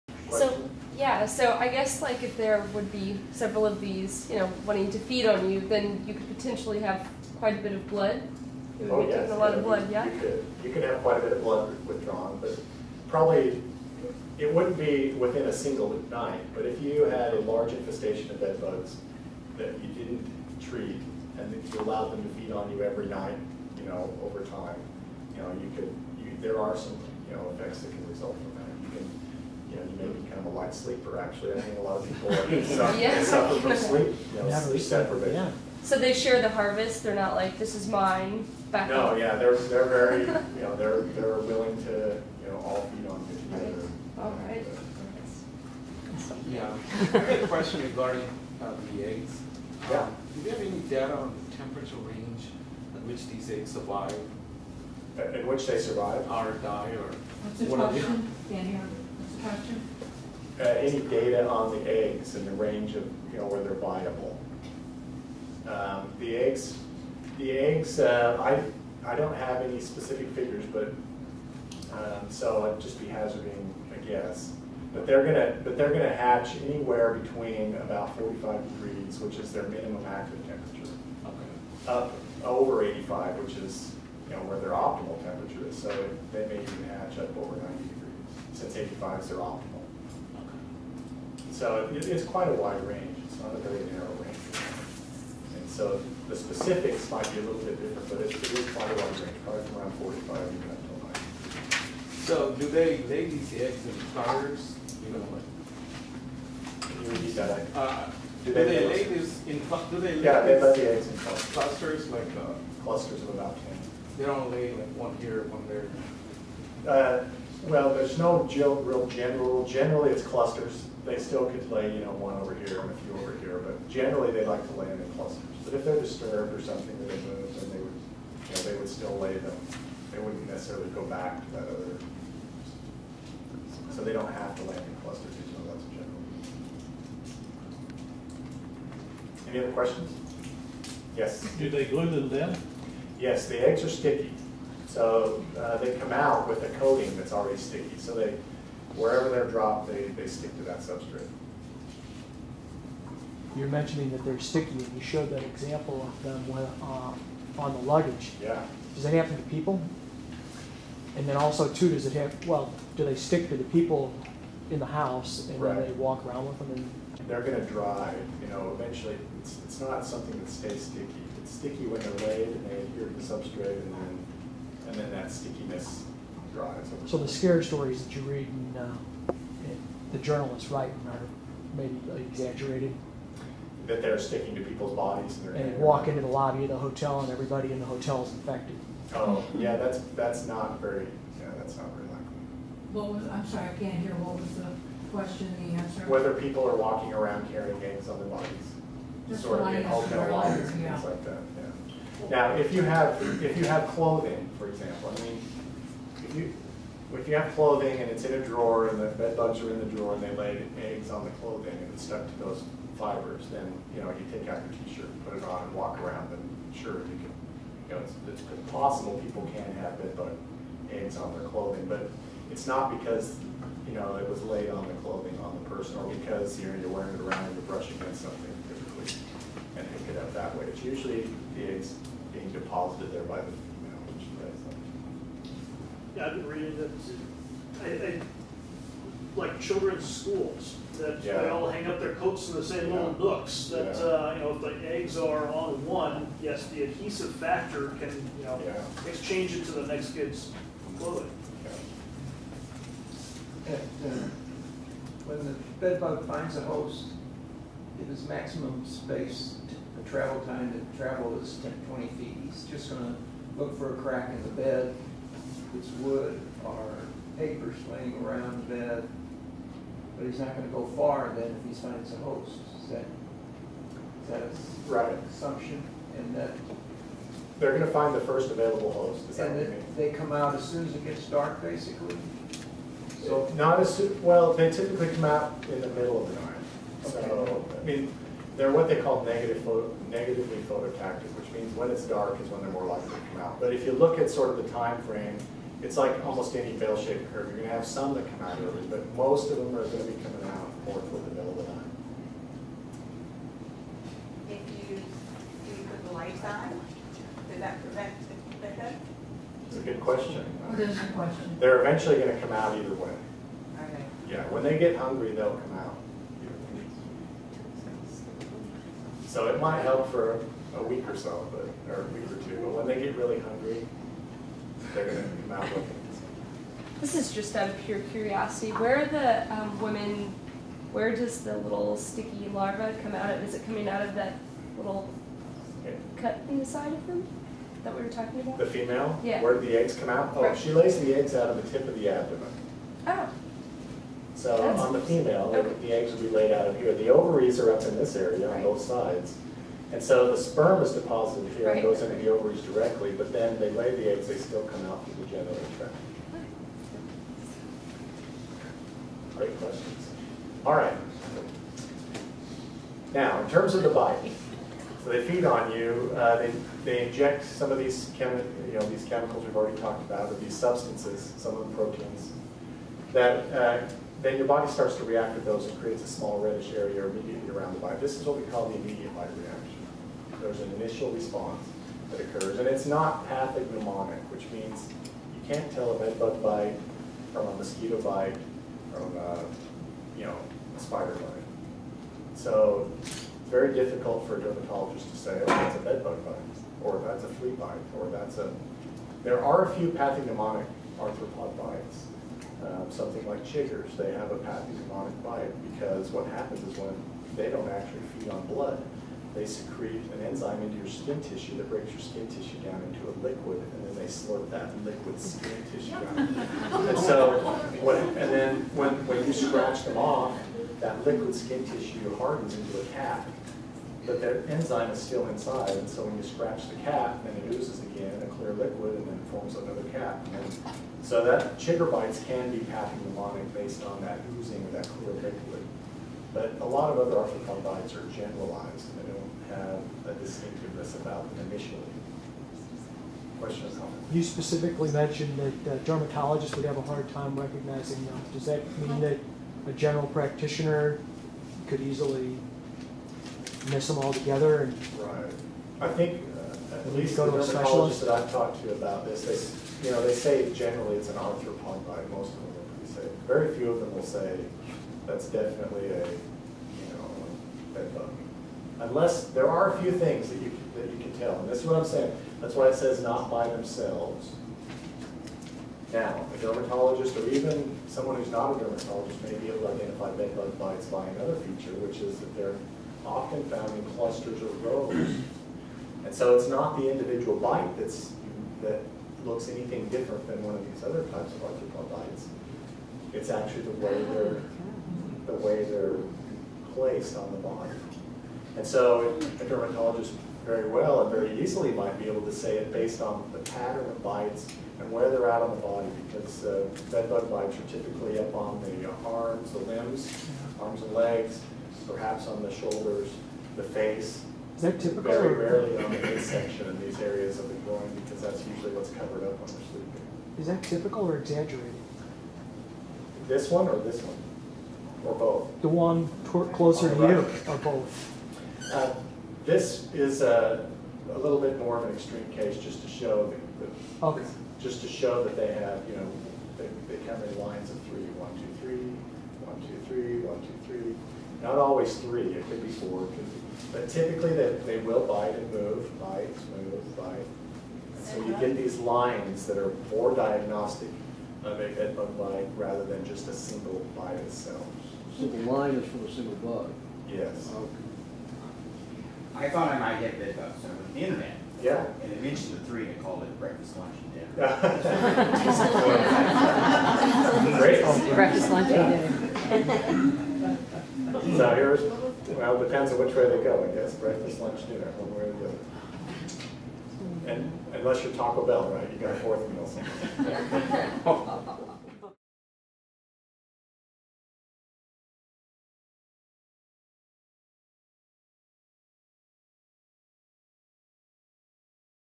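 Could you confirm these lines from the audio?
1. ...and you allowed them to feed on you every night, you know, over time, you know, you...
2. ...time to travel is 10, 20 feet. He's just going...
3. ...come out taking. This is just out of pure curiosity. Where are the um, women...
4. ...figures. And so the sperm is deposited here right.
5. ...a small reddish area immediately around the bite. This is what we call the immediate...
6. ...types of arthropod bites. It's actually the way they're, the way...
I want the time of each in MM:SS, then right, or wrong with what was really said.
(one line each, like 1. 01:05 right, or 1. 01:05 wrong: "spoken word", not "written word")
1. 00:21 right
2. 04:20 right
3. 05:25 wrong: "looking", not "taking"
4. 05:48 wrong: "sides", not "figures"
5. 06:16 right
6. 08:11 right.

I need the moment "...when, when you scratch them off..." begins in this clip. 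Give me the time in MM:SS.
06:58.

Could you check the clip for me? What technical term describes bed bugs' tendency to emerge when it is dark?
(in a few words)
negatively phototactic.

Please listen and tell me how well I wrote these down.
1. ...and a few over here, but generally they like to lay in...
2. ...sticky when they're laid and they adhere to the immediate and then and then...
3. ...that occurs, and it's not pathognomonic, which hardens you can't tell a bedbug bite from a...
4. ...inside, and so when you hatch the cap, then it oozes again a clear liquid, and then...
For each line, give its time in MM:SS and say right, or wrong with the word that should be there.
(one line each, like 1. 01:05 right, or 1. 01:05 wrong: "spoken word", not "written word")
1. 02:02 right
2. 02:51 wrong: "substrate", not "immediate"
3. 06:22 wrong: "means", not "hardens"
4. 07:05 wrong: "scratch", not "hatch".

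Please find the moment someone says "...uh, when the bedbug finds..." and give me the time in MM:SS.
04:14.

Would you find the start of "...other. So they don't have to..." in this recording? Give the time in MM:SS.
02:11.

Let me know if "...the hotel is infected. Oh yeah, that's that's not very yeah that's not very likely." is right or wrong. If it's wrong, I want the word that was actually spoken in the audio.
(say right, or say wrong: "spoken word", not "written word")
right.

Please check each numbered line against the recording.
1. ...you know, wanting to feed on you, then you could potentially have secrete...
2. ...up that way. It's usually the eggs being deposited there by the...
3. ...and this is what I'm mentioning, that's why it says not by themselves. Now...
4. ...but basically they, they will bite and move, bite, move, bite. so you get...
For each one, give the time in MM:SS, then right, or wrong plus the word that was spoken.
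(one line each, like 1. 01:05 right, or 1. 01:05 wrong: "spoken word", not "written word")
1. 00:04 wrong: "quite", not "secrete"
2. 03:50 right
3. 07:51 wrong: "saying", not "mentioning"
4. 09:03 wrong: "typically", not "basically".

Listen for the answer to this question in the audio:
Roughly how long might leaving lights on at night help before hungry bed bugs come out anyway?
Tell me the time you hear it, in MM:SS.
05:22.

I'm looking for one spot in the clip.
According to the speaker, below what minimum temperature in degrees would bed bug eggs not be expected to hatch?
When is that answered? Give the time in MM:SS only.
01:18.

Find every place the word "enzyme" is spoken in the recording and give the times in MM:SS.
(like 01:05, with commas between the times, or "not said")
06:50, 07:04.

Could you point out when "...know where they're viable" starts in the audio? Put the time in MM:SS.
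01:03.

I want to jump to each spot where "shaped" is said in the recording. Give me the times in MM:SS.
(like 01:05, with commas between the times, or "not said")
04:56.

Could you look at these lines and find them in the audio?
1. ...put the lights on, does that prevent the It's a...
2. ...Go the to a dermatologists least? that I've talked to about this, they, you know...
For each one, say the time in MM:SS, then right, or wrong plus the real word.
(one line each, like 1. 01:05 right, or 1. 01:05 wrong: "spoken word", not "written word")
1. 05:05 right
2. 07:37 wrong: "specialist", not "least".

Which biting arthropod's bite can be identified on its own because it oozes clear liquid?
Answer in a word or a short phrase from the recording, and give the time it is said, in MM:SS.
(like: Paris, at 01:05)
chiggers, at 06:43.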